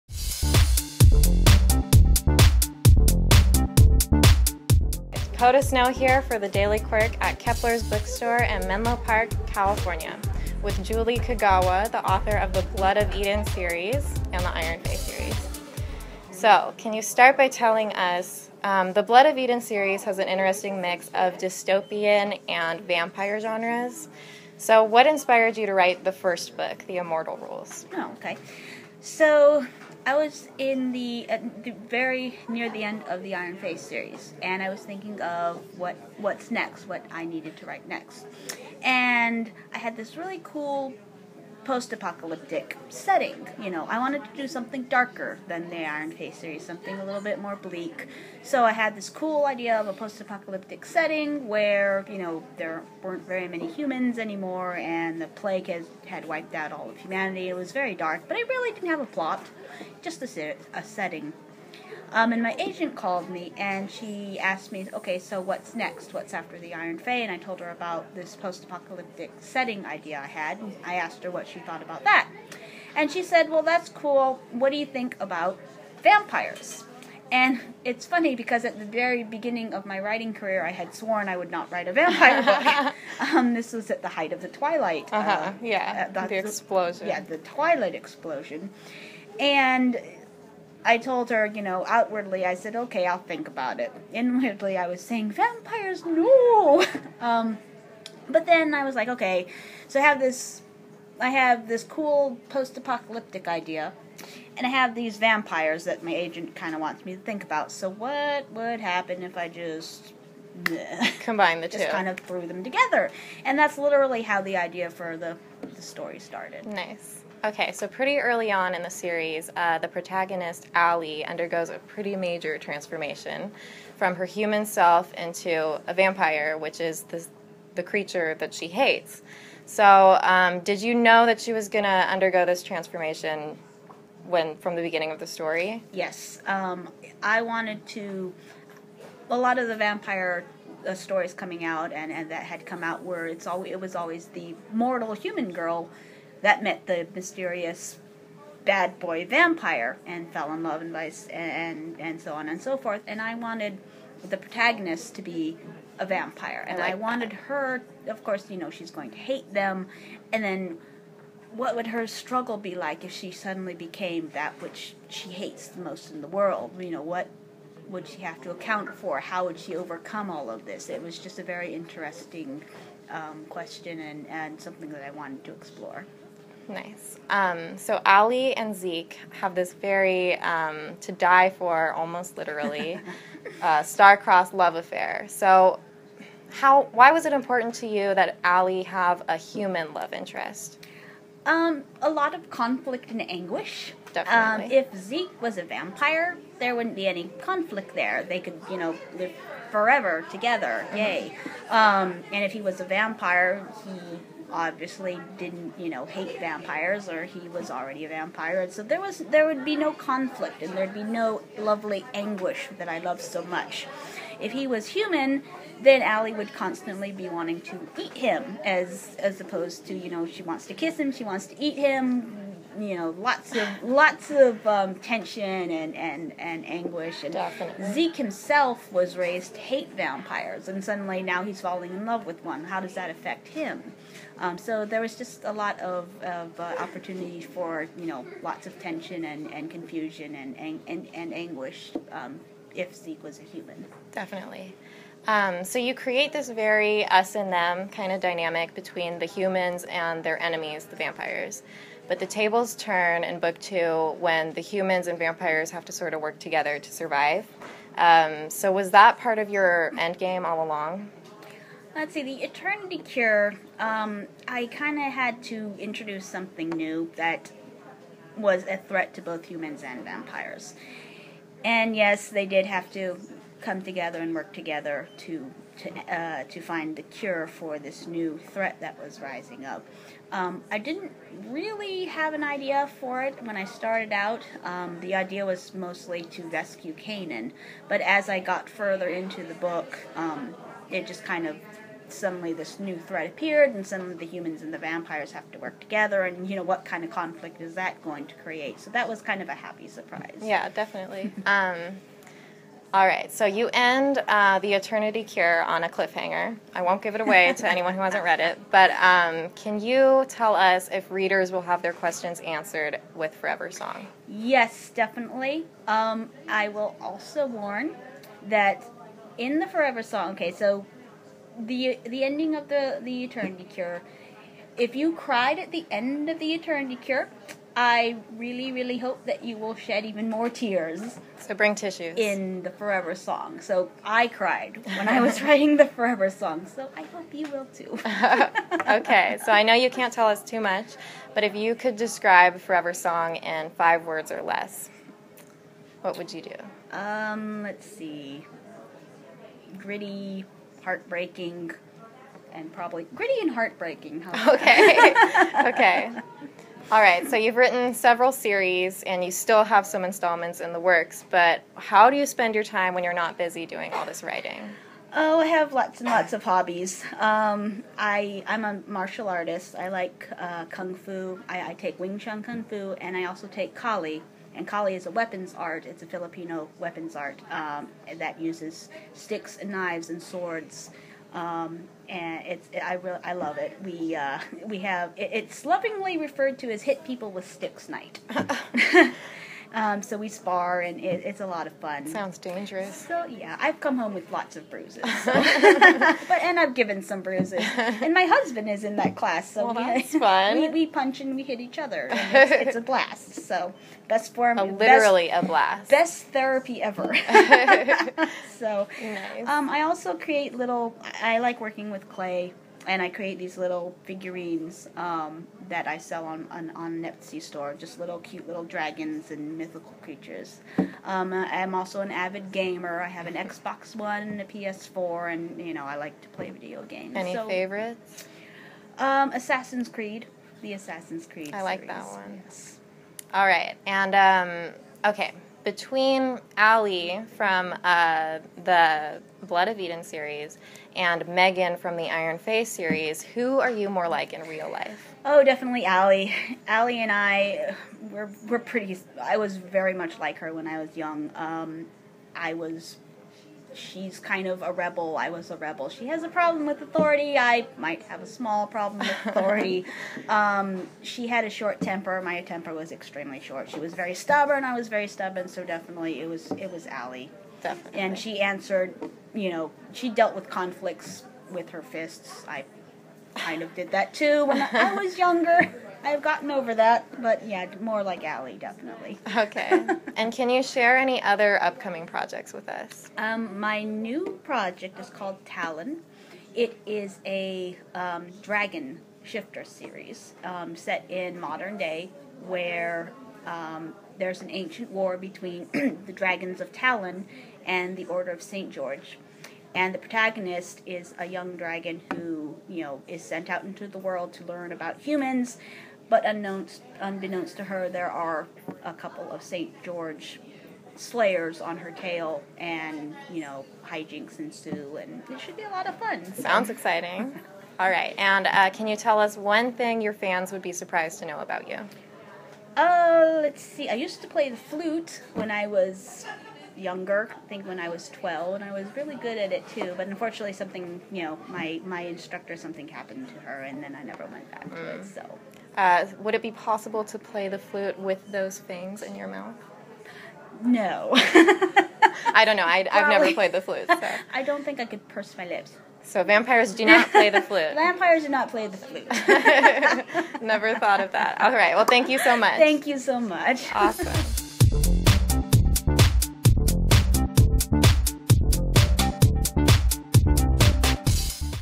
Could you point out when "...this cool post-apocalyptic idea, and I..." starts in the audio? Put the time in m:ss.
1:41.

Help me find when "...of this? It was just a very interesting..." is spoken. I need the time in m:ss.
2:50.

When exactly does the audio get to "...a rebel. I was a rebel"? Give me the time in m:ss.
7:34.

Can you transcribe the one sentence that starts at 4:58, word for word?
So that was kind of a happy surprise.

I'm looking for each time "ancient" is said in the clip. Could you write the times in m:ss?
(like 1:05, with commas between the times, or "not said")
8:14.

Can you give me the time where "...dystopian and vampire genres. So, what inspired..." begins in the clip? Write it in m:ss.
0:21.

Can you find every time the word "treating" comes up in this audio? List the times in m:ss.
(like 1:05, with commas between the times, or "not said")
not said.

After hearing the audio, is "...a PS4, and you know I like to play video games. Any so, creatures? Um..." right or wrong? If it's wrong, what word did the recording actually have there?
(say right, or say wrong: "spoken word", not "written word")
wrong: "favorites", not "creatures".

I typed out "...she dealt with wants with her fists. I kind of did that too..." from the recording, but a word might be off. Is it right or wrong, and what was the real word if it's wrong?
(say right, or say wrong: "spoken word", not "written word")
wrong: "conflicts", not "wants".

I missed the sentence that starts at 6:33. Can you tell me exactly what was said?
So yeah, I've come home with lots of bruises, so.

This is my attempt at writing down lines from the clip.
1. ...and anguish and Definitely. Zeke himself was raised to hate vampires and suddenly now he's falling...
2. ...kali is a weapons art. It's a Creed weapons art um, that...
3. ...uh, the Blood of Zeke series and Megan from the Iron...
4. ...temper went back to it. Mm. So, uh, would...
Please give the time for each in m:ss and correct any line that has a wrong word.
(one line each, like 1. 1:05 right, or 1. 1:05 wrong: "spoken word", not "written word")
1. 3:46 right
2. 6:14 wrong: "Filipino", not "Creed"
3. 7:17 wrong: "Eden", not "Zeke"
4. 8:54 wrong: "never", not "temper".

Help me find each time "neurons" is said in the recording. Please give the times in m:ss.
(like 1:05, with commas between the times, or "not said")
not said.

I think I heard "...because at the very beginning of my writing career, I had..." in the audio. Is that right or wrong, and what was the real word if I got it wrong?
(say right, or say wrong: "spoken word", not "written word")
right.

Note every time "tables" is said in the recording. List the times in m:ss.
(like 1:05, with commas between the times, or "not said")
4:12.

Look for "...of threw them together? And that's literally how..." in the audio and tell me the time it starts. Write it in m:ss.
1:52.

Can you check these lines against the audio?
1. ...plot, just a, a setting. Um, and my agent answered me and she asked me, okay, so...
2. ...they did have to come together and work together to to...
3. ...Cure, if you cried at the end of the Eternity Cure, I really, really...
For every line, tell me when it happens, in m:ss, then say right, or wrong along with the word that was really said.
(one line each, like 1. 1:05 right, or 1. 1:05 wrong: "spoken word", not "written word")
1. 0:59 wrong: "called", not "answered"
2. 4:32 right
3. 5:23 right.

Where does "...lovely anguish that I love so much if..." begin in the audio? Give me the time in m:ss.
3:31.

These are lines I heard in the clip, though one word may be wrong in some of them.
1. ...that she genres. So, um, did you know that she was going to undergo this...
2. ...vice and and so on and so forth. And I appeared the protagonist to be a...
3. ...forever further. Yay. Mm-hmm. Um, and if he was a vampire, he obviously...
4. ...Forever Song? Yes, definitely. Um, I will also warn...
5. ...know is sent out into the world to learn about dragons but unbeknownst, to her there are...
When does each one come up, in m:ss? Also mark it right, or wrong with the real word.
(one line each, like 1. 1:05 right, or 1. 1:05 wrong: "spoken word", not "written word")
1. 2:08 wrong: "hates", not "genres"
2. 2:30 wrong: "wanted", not "appeared"
3. 3:19 wrong: "together", not "further"
4. 5:13 right
5. 8:22 wrong: "humans", not "dragons".